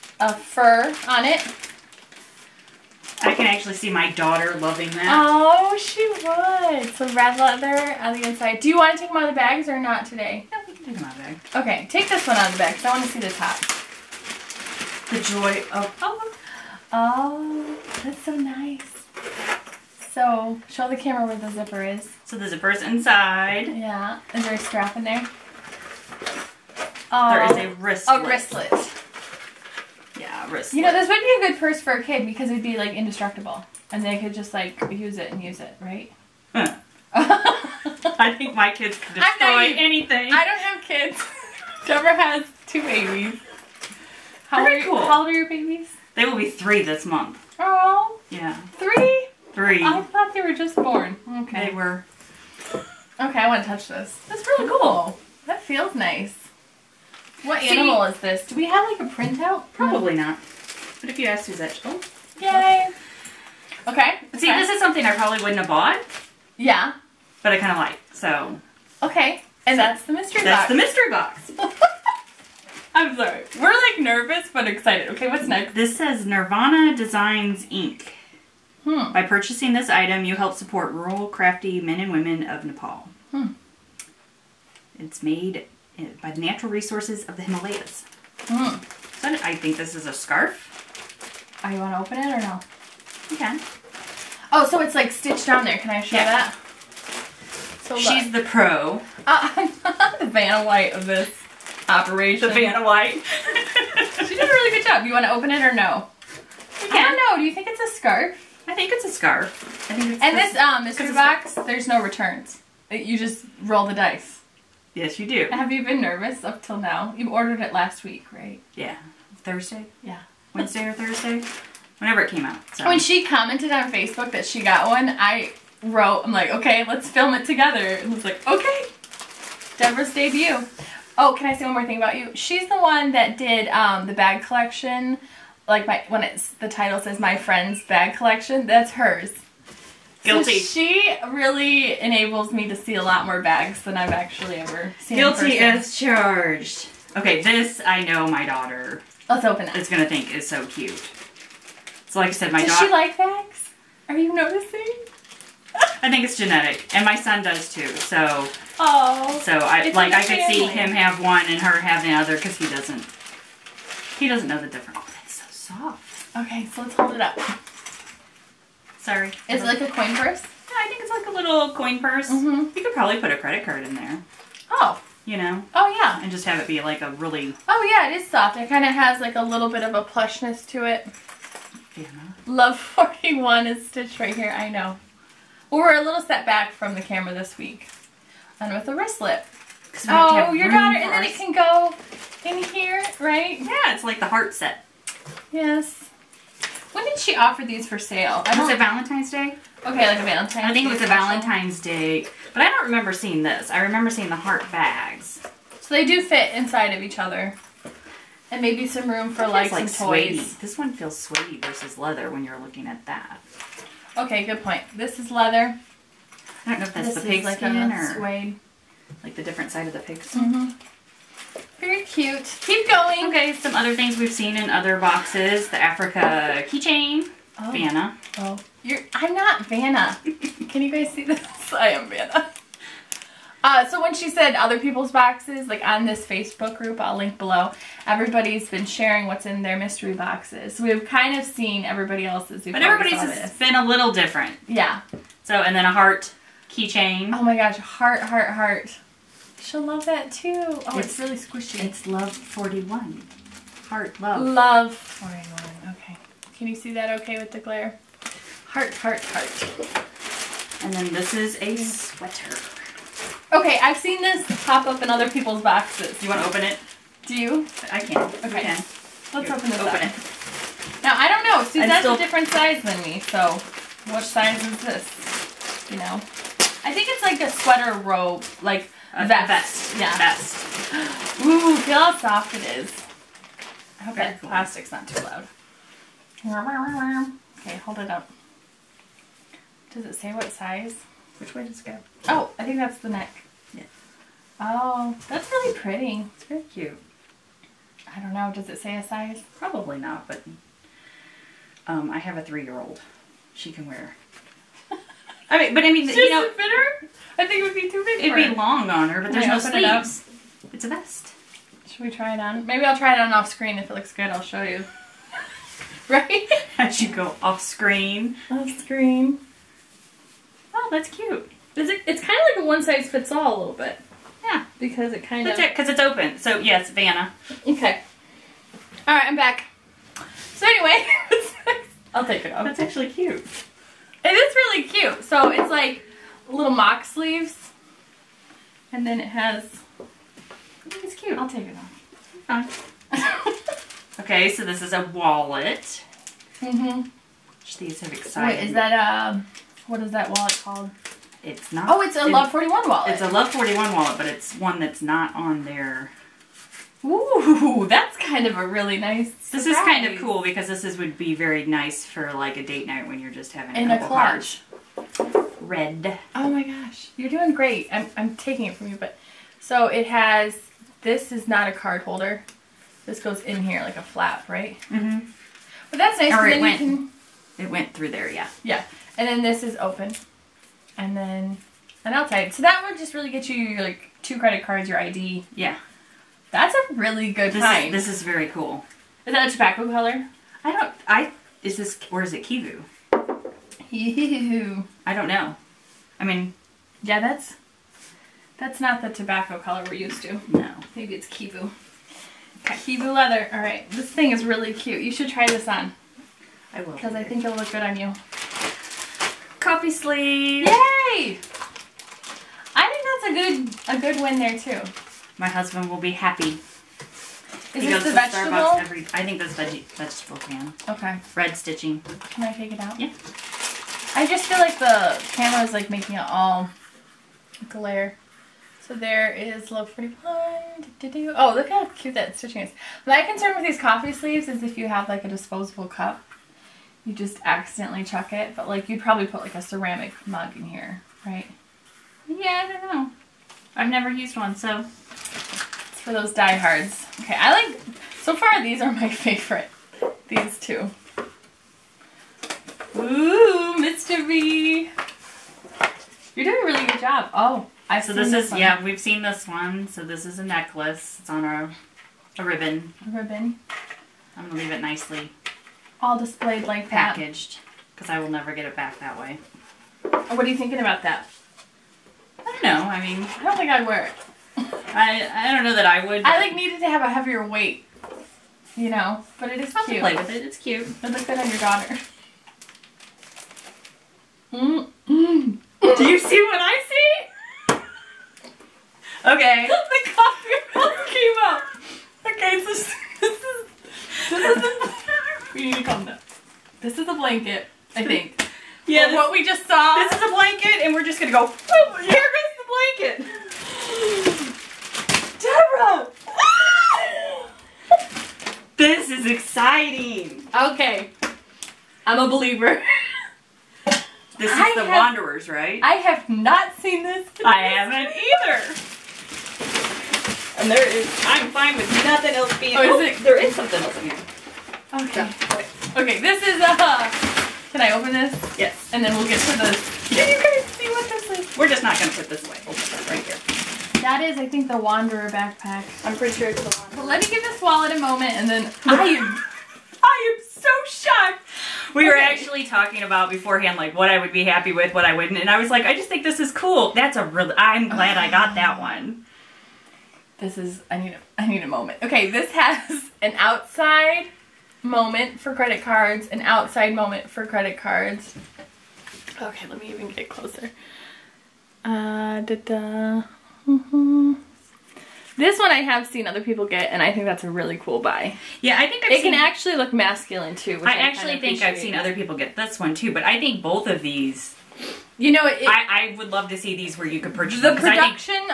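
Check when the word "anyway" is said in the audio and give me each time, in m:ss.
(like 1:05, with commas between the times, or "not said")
5:30.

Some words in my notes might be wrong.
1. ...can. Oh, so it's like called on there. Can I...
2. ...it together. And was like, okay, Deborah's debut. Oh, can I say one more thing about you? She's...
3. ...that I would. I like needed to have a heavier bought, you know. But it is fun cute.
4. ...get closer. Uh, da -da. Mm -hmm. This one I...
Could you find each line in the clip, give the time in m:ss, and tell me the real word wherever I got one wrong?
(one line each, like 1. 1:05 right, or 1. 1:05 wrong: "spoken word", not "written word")
1. 1:33 wrong: "stitched", not "called"
2. 2:07 right
3. 7:55 wrong: "weight", not "bought"
4. 9:20 right.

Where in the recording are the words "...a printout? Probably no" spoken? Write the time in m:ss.
0:59.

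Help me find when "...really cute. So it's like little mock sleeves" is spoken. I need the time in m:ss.
5:34.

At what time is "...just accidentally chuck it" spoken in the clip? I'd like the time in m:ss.
7:17.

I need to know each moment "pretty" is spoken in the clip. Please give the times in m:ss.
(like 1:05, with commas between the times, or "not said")
4:55, 7:09, 8:56.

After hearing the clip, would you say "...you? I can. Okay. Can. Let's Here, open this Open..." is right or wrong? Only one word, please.
right.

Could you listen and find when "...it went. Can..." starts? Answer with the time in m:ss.
6:16.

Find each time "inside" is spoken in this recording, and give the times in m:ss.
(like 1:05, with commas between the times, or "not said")
0:08, 0:22, 3:26.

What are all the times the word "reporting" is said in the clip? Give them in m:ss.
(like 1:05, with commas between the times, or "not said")
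not said.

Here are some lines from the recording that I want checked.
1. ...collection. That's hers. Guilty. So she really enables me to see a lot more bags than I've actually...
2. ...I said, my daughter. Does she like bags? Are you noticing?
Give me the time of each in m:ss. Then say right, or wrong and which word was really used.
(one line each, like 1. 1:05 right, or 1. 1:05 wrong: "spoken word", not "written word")
1. 2:18 right
2. 2:32 right.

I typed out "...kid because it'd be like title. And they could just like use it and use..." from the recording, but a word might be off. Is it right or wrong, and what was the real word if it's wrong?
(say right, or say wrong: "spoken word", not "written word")
wrong: "indestructible", not "title".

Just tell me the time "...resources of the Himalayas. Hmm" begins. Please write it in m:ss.
1:26.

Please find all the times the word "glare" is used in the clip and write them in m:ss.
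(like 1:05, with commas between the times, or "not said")
4:17, 7:07.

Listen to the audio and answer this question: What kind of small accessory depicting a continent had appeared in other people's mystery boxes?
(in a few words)
Africa keychain.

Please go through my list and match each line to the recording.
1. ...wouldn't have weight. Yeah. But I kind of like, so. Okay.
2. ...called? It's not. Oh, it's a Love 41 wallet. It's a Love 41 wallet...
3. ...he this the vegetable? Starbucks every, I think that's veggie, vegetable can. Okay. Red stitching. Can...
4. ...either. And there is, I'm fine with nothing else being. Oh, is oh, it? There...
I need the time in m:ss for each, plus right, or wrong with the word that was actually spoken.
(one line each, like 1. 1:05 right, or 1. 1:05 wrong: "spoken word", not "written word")
1. 1:05 wrong: "bought", not "weight"
2. 5:50 right
3. 6:57 right
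4. 8:38 right.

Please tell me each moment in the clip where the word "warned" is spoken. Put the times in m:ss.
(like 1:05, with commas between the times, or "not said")
not said.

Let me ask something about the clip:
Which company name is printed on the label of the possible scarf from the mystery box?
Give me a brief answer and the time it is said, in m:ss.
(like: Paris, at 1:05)
Nirvana Designs Inc., at 1:16.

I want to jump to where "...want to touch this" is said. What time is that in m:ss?
0:53.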